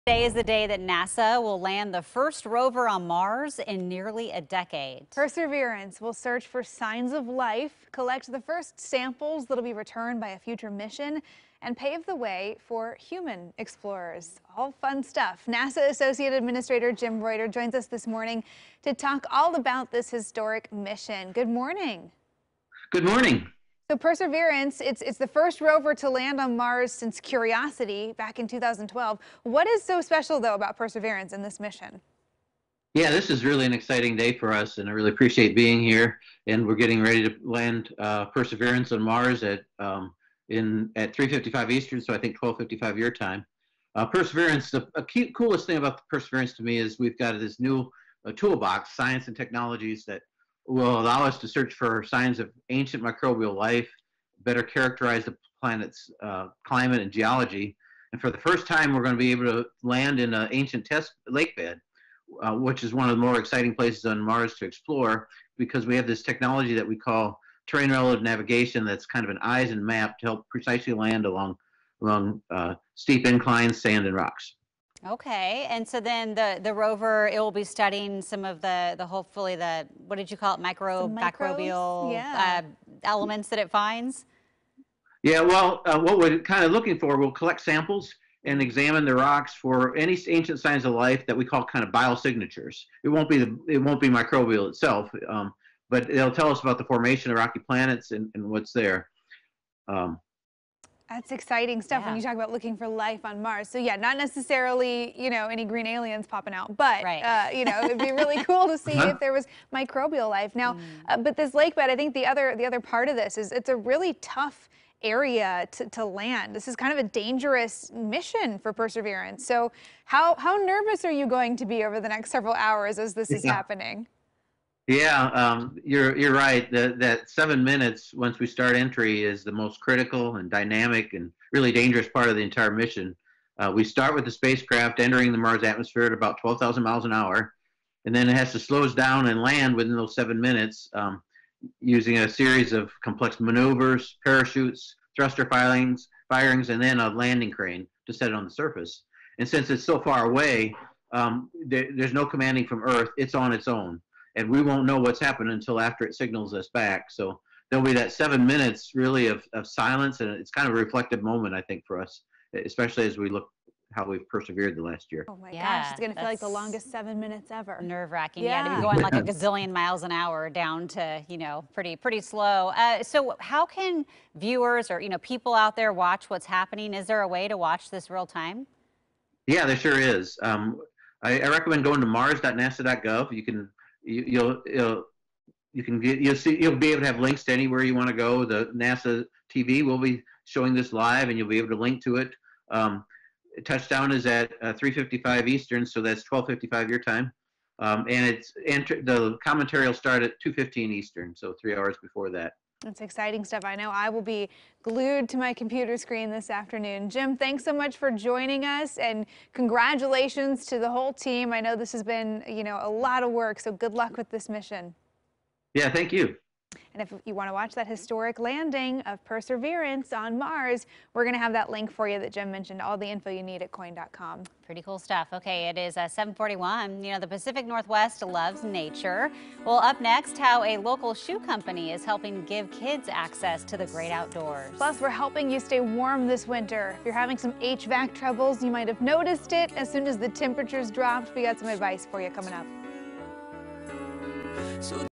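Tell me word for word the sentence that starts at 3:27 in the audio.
Jim, thanks so much for joining us and congratulations to the whole team.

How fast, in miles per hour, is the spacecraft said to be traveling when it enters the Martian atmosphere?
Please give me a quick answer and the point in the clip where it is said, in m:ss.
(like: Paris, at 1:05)
12,000 miles an hour, at 2:16.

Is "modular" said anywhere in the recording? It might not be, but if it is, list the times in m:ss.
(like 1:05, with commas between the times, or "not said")
not said.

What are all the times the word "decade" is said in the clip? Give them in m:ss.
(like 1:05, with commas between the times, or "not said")
0:04.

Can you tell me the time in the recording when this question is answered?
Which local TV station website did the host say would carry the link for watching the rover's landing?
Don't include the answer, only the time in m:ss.
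3:43.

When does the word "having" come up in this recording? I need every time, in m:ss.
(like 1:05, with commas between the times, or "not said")
3:57.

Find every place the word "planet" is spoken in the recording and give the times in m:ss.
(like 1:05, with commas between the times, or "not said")
0:55, 1:37.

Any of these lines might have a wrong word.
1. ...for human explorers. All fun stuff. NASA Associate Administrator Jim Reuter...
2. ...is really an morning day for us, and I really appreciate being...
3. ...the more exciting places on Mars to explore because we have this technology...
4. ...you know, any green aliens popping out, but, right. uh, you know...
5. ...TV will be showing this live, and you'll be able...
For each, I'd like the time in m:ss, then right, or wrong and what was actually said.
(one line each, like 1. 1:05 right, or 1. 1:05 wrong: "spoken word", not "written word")
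1. 0:12 right
2. 0:33 wrong: "exciting", not "morning"
3. 1:03 right
4. 1:45 right
5. 3:09 right.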